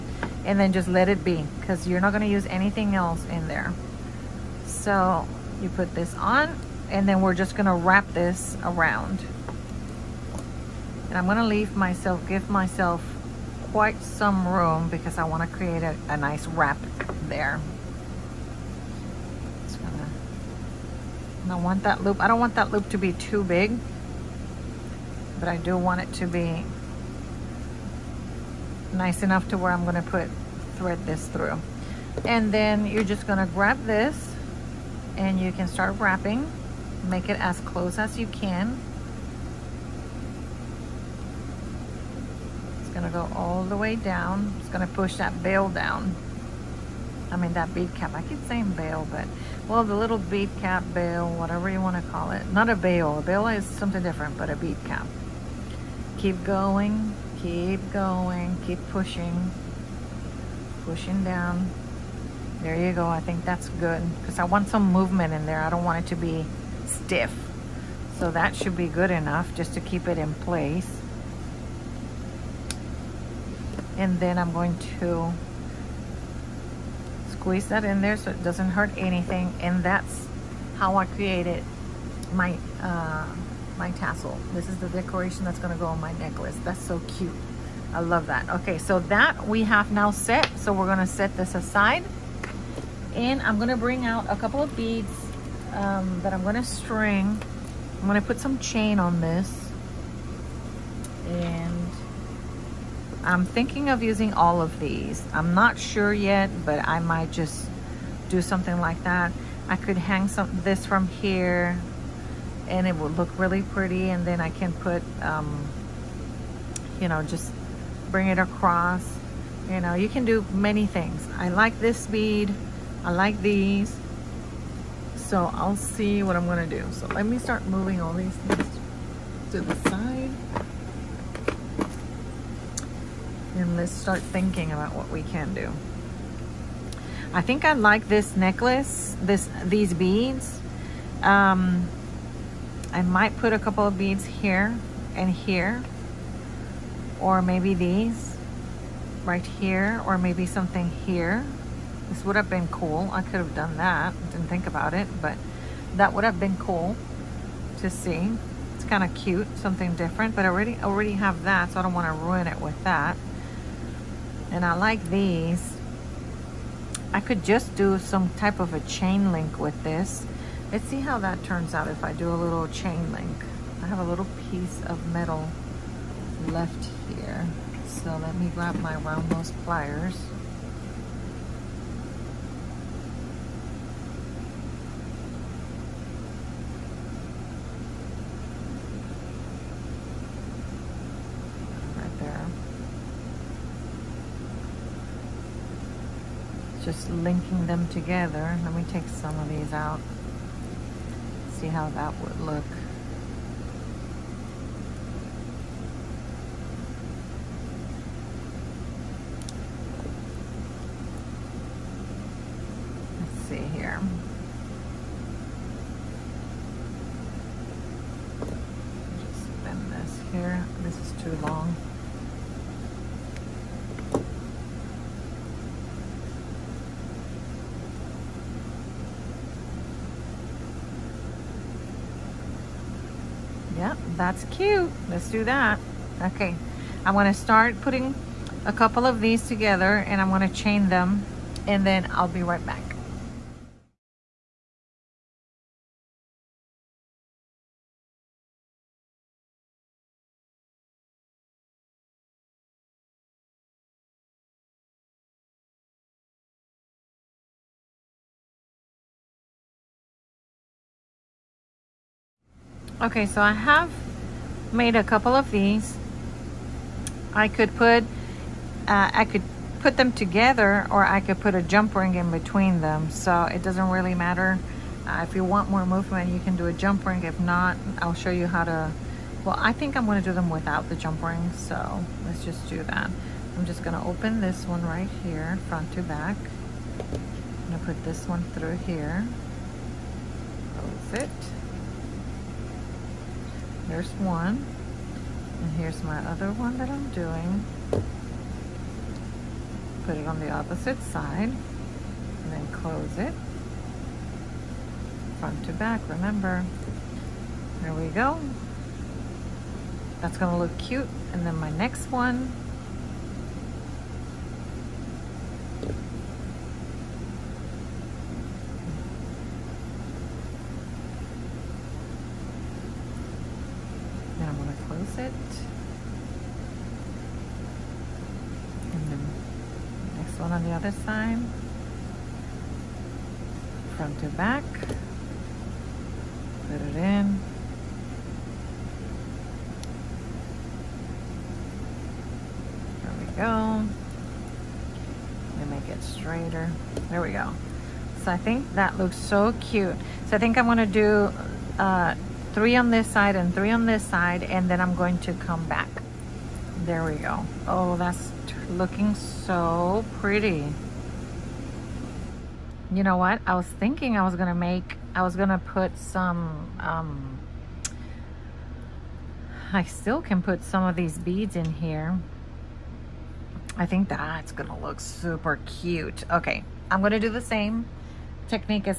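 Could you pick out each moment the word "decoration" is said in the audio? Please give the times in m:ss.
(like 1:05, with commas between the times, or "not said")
1:24.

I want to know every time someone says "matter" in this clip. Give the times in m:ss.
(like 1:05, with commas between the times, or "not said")
4:34.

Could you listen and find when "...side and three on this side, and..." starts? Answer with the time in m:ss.
5:53.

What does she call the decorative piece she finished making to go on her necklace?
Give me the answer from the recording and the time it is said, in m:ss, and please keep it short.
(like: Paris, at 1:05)
tassel, at 1:23.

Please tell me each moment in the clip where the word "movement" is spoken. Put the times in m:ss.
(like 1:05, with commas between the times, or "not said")
1:04, 4:35.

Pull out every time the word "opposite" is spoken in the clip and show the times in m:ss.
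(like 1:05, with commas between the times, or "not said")
5:00.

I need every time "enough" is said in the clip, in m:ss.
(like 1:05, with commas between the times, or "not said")
0:29, 1:09.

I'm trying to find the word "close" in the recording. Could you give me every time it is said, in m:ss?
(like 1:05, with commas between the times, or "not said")
0:37, 4:50, 5:02.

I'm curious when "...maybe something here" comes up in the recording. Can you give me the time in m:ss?
2:30.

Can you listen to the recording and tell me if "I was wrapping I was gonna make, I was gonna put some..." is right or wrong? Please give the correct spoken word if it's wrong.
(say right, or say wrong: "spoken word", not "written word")
wrong: "thinking", not "wrapping".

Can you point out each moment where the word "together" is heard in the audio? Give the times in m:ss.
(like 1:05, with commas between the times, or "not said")
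3:17, 3:59, 4:30.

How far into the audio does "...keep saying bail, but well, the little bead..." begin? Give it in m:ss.
0:48.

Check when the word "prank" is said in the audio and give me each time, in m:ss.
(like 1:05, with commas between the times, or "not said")
not said.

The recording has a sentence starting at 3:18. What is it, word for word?
Let me take some of these out, see how that would look.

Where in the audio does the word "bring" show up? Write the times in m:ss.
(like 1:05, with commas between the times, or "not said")
1:33, 1:58.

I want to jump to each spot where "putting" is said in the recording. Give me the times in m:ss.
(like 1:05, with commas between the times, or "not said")
3:57.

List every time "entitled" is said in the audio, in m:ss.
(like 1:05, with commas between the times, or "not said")
not said.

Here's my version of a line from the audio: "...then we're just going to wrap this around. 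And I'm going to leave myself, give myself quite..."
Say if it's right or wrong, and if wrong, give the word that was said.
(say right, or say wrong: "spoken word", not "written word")
right.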